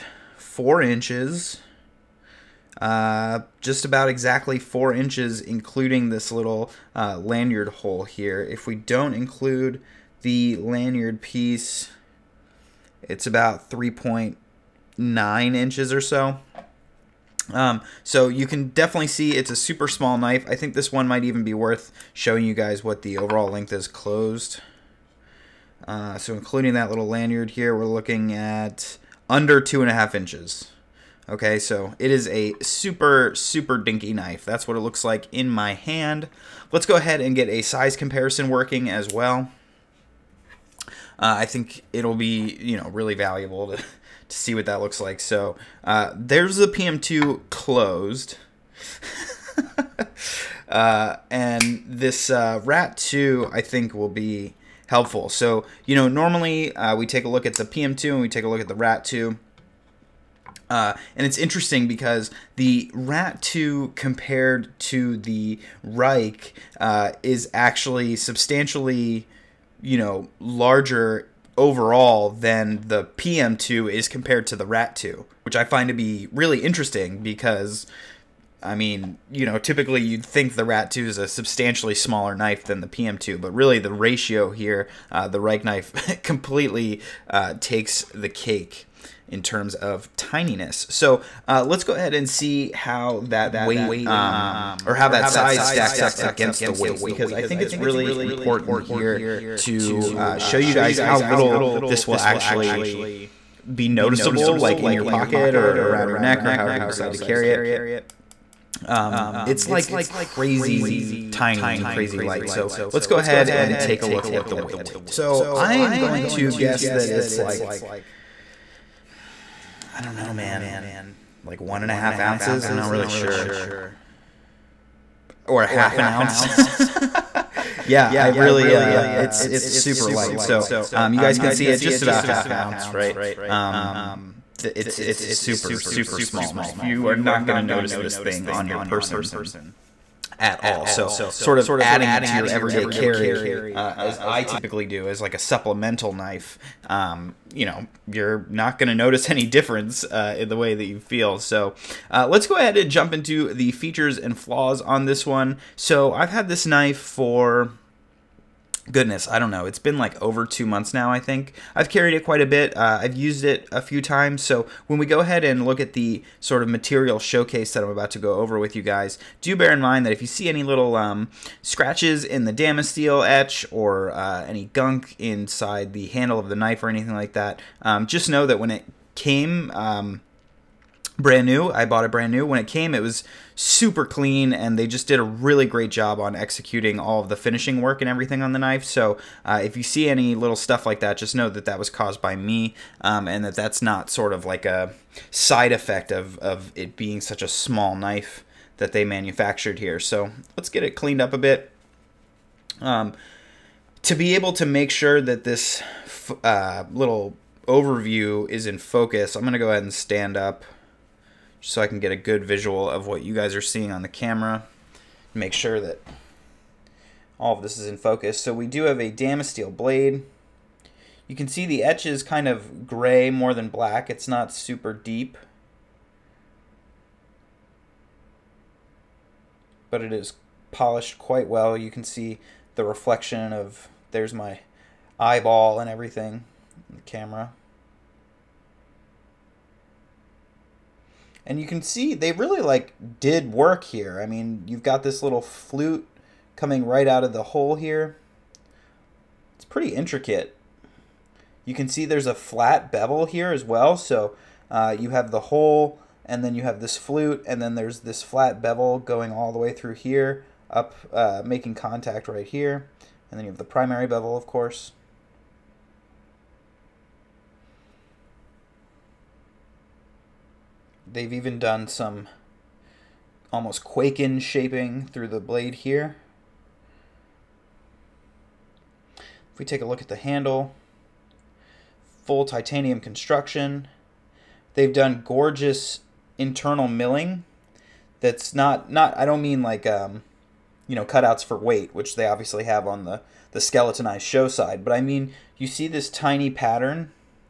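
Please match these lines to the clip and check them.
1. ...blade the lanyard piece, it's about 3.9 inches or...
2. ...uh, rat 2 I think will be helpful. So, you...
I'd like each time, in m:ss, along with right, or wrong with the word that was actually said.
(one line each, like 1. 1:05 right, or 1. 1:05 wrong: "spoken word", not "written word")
1. 0:09 wrong: "include", not "blade"
2. 0:52 right.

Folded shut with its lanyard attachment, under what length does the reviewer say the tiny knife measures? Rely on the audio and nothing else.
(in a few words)
2.5 inches.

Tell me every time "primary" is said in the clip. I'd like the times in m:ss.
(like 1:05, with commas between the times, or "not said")
4:23.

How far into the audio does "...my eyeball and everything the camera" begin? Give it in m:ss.
3:54.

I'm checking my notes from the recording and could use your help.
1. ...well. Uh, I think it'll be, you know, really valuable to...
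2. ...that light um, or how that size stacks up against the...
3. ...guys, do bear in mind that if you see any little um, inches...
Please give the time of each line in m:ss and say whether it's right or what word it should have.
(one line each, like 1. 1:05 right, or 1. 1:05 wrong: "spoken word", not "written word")
1. 0:39 right
2. 1:33 wrong: "weight", not "light"
3. 2:48 wrong: "scratches", not "inches".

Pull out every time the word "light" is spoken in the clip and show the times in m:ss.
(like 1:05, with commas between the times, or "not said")
1:52, 2:10.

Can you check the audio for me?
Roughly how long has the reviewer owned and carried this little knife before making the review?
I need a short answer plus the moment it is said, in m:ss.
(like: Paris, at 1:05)
over 2 months, at 2:40.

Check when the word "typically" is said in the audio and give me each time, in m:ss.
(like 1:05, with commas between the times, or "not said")
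1:19, 2:24.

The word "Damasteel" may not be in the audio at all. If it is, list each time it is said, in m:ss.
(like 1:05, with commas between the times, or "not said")
2:52, 3:39.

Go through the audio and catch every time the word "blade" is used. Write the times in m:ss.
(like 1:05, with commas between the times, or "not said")
3:39, 4:35.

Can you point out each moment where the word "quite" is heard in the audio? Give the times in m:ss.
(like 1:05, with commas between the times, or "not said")
2:42, 3:51.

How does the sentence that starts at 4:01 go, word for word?
and you can see they really like did work here.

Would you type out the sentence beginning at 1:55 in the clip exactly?
So I am going to guess that it's like I don't know, man.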